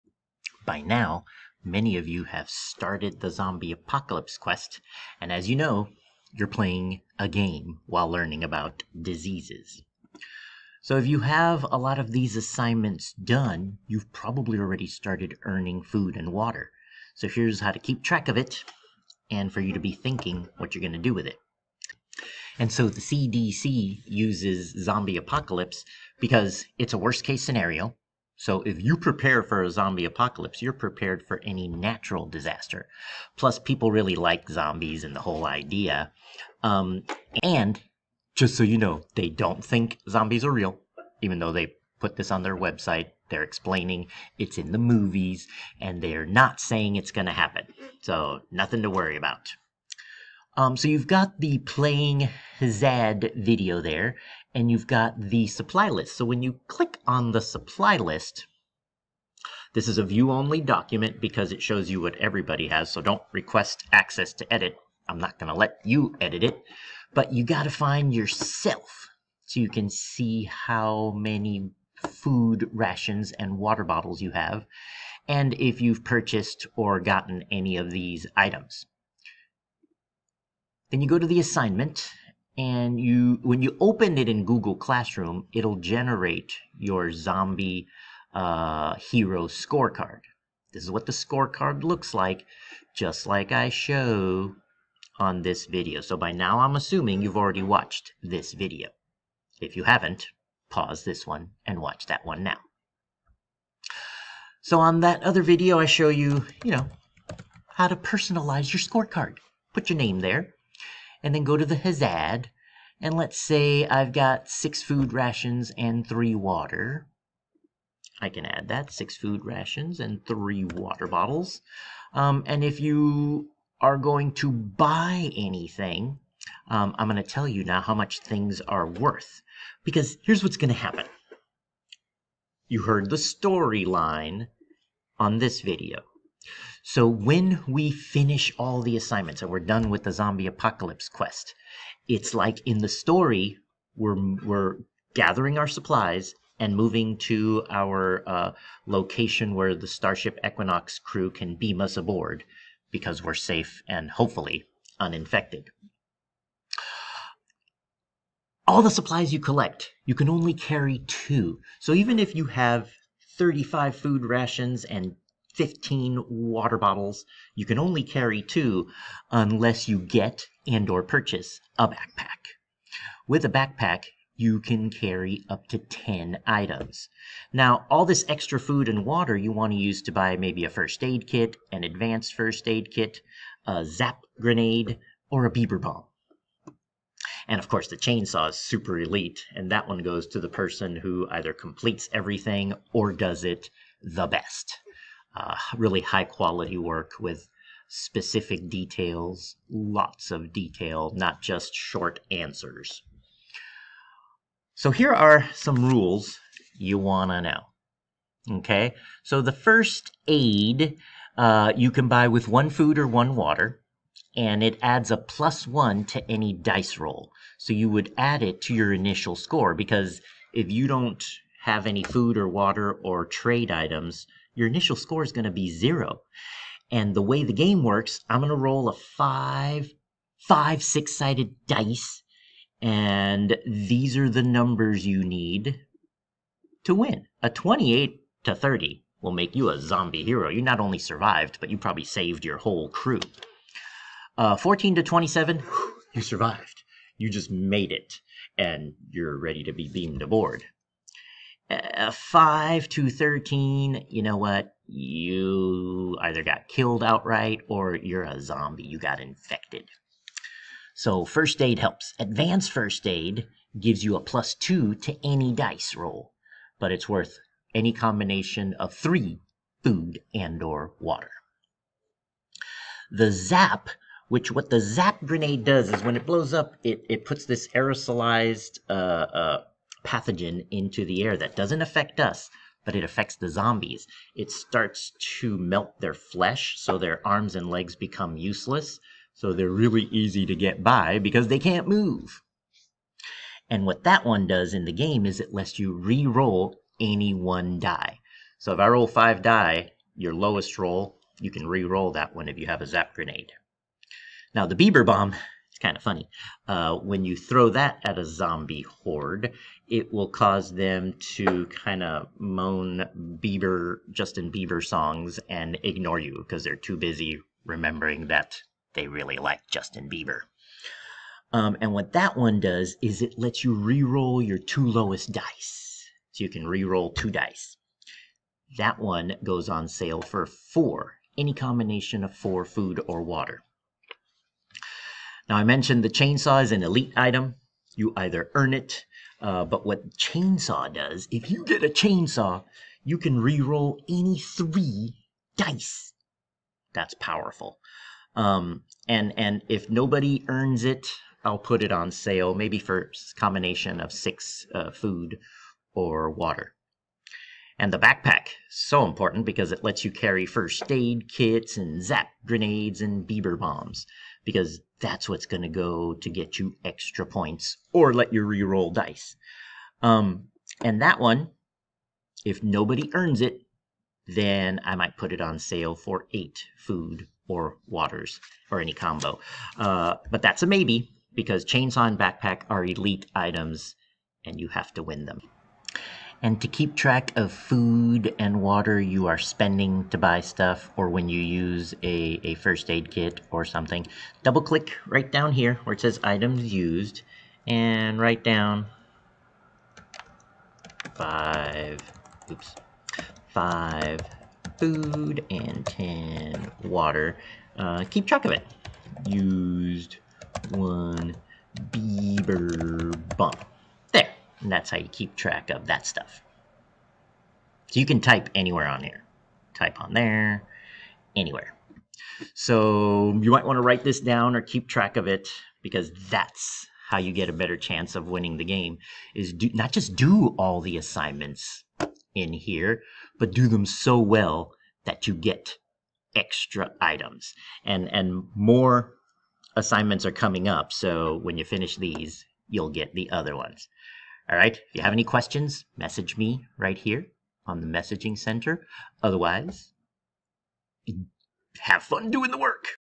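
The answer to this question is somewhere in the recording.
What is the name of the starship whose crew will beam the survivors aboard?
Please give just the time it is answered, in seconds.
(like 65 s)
149 s.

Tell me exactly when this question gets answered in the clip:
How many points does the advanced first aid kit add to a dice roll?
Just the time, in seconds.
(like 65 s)
264 s.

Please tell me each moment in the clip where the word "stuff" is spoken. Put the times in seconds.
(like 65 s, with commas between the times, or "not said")
390 s, 416 s.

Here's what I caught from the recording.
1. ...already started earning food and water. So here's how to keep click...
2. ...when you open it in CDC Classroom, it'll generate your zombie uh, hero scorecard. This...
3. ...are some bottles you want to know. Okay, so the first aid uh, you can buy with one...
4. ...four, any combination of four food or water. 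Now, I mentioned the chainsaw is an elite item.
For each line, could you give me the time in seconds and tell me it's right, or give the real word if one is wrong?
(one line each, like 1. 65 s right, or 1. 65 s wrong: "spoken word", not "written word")
1. 14 s wrong: "track", not "click"
2. 83 s wrong: "Google", not "CDC"
3. 205 s wrong: "rules", not "bottles"
4. 330 s right.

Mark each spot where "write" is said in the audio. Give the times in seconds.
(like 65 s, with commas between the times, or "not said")
398 s, 423 s.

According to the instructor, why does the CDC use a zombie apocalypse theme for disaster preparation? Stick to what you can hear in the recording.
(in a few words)
worst case scenario.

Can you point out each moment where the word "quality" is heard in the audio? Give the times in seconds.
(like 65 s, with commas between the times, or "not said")
196 s.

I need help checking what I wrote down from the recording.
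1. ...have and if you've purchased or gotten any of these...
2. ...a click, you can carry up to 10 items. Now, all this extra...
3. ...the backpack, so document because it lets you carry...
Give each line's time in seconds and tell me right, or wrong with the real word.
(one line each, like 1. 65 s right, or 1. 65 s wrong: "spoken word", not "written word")
1. 74 s right
2. 173 s wrong: "backpack", not "click"
3. 357 s wrong: "important", not "document".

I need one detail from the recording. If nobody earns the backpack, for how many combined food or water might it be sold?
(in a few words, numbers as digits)
8.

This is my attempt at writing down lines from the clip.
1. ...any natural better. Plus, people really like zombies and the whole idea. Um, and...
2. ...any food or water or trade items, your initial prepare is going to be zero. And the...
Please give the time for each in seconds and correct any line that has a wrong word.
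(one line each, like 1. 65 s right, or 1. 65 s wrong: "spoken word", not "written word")
1. 31 s wrong: "disaster", not "better"
2. 221 s wrong: "score", not "prepare".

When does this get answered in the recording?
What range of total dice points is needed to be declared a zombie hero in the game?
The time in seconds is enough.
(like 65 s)
237 s.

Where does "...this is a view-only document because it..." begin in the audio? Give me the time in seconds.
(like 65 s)
59 s.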